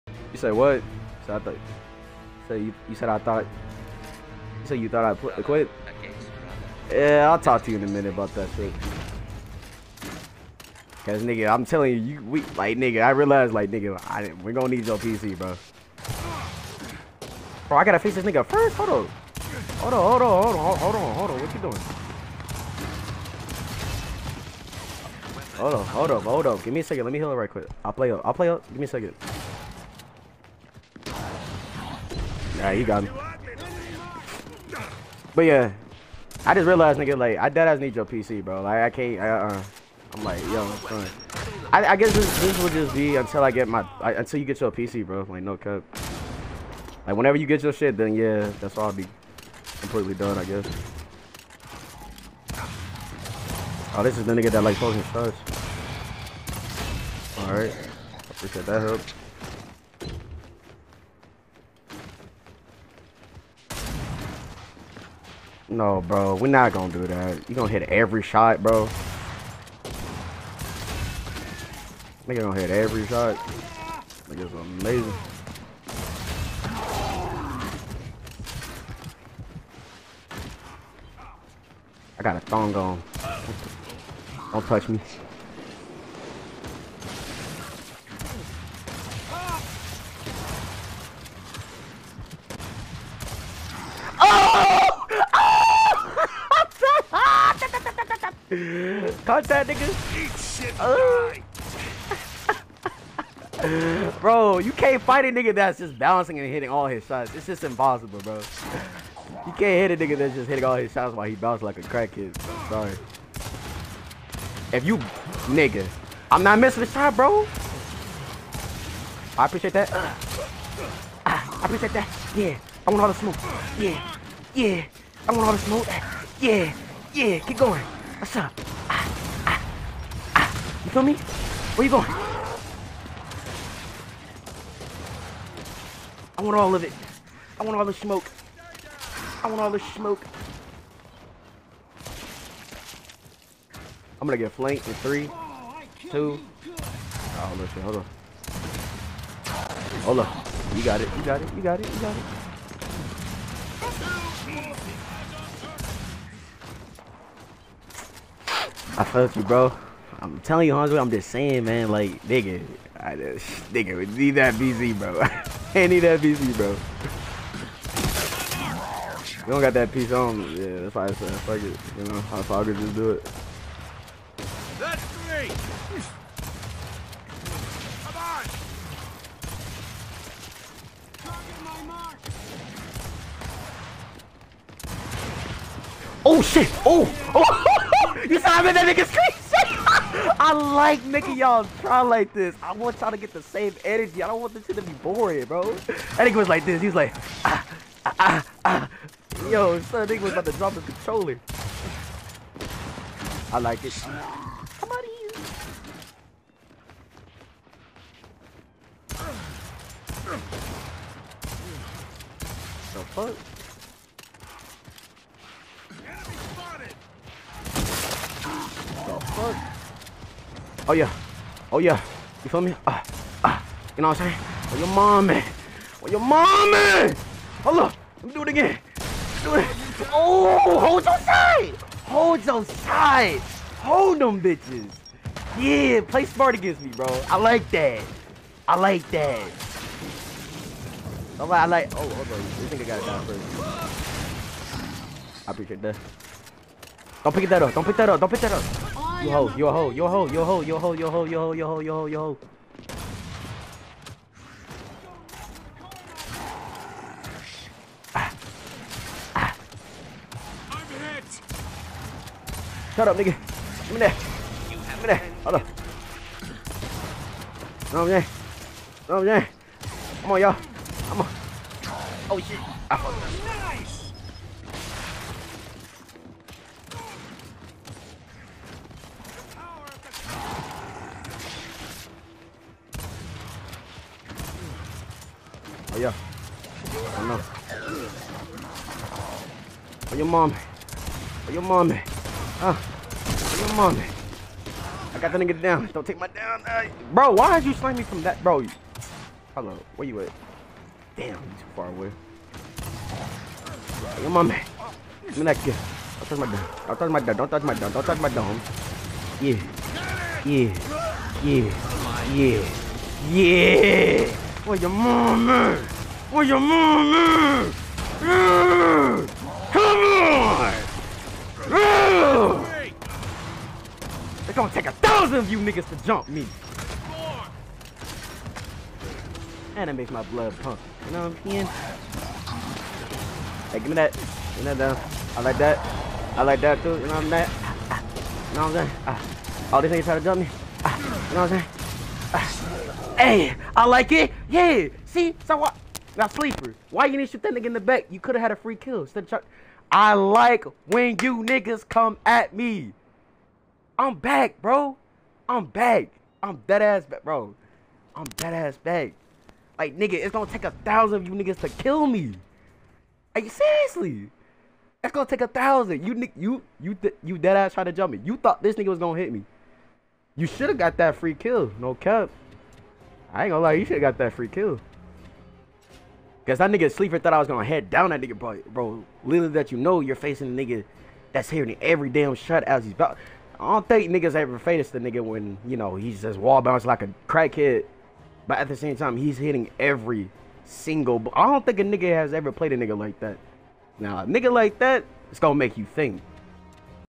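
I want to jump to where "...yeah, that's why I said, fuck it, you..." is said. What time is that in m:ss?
2:50.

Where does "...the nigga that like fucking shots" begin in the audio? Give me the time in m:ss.
0:54.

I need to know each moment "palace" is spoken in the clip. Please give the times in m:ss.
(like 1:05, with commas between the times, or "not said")
not said.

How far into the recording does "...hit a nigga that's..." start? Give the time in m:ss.
1:49.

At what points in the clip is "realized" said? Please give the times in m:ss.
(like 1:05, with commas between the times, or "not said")
0:13, 0:36.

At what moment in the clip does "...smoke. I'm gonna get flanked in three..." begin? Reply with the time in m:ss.
2:19.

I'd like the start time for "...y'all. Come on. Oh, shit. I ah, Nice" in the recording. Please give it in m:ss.
4:30.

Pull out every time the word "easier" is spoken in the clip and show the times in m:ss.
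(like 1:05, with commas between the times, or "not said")
not said.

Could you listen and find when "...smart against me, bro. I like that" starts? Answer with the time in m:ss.
3:56.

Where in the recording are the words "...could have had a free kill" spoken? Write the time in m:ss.
5:48.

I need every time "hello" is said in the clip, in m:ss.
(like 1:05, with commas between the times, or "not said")
4:59.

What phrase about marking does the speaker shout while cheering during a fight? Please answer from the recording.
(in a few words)
Target my mark.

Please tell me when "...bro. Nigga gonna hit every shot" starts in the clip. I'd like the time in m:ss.
1:08.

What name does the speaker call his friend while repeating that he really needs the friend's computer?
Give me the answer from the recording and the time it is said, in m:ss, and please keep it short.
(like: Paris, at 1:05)
Hanzo, at 2:40.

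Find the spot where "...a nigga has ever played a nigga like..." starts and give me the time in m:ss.
6:31.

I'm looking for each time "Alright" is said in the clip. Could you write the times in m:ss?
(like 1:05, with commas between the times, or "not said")
0:32, 0:57.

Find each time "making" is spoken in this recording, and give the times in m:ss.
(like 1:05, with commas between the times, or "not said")
3:11.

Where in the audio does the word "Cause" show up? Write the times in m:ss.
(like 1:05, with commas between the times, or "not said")
0:11, 6:16.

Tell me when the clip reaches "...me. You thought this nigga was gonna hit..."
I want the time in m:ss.
6:08.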